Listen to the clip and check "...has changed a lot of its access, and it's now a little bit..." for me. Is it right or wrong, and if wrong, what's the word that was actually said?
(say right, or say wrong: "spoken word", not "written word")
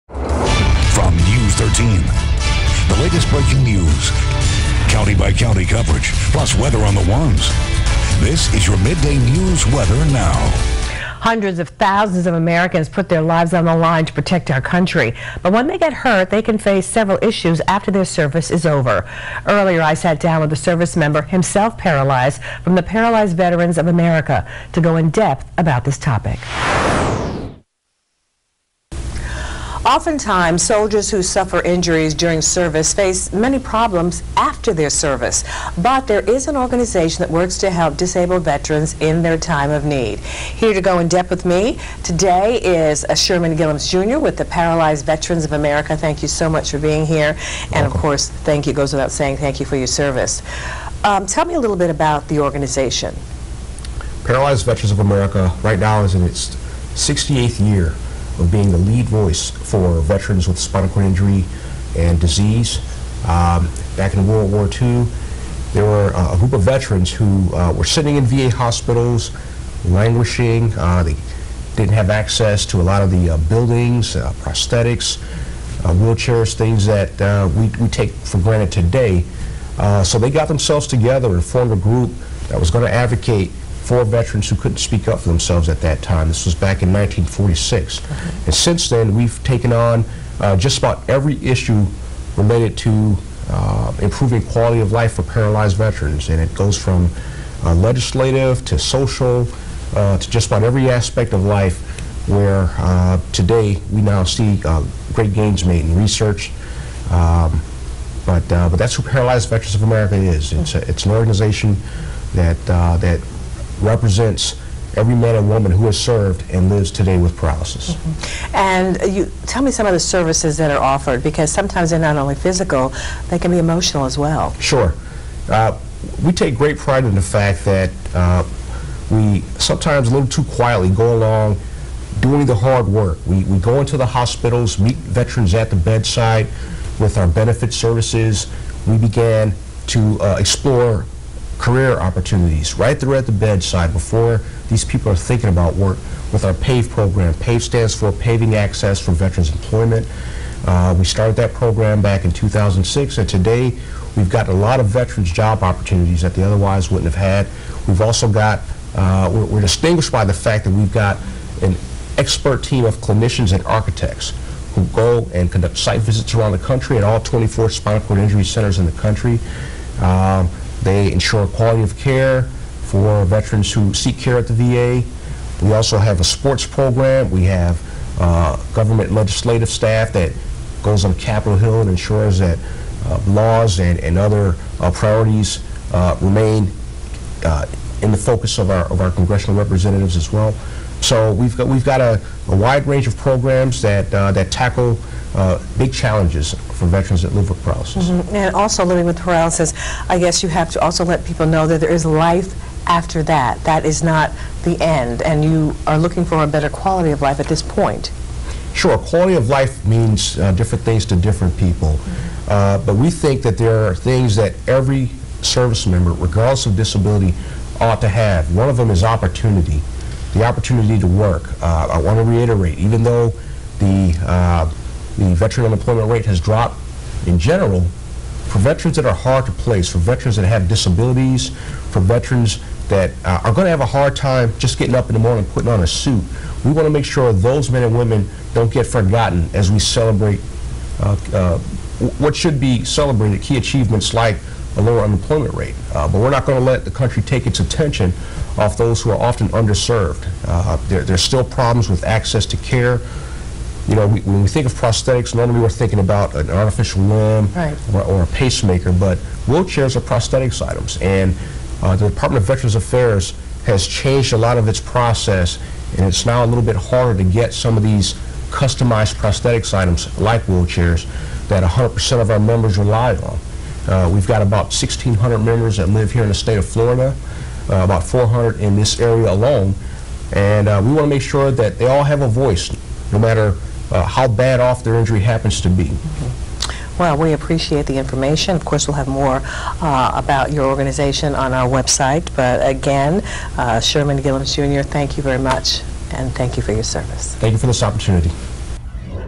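wrong: "process", not "access".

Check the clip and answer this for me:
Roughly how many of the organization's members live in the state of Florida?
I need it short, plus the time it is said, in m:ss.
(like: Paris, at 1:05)
1,600, at 4:34.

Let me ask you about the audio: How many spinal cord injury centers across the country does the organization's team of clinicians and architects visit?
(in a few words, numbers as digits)
24.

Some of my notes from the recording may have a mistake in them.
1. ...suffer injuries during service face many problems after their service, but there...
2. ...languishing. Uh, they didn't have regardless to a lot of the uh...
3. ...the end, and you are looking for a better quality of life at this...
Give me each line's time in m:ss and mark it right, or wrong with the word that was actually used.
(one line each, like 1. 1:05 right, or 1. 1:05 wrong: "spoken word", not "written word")
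1. 0:31 right
2. 1:09 wrong: "access", not "regardless"
3. 3:24 right.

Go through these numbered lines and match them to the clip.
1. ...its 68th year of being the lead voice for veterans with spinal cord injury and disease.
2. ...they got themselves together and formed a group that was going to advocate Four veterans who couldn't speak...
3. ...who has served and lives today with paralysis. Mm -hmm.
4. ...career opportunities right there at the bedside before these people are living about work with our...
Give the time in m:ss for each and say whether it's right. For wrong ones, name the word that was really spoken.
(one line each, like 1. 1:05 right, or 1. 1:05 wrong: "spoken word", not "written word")
1. 0:56 right
2. 1:20 right
3. 1:55 right
4. 2:21 wrong: "thinking", not "living".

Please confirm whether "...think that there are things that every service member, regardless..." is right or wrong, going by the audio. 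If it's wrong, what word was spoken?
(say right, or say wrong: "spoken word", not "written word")
right.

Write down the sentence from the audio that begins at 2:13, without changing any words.
We, we go into the hospitals, meet veterans at the bedside with our benefit services.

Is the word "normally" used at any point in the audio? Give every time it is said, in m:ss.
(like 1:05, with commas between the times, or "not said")
4:15.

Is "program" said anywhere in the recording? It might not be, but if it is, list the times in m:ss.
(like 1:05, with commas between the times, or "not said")
2:26, 2:31, 2:56, 3:13.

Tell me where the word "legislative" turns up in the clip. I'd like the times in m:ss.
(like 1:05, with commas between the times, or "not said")
1:37, 2:59.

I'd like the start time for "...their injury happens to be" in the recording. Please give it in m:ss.
4:44.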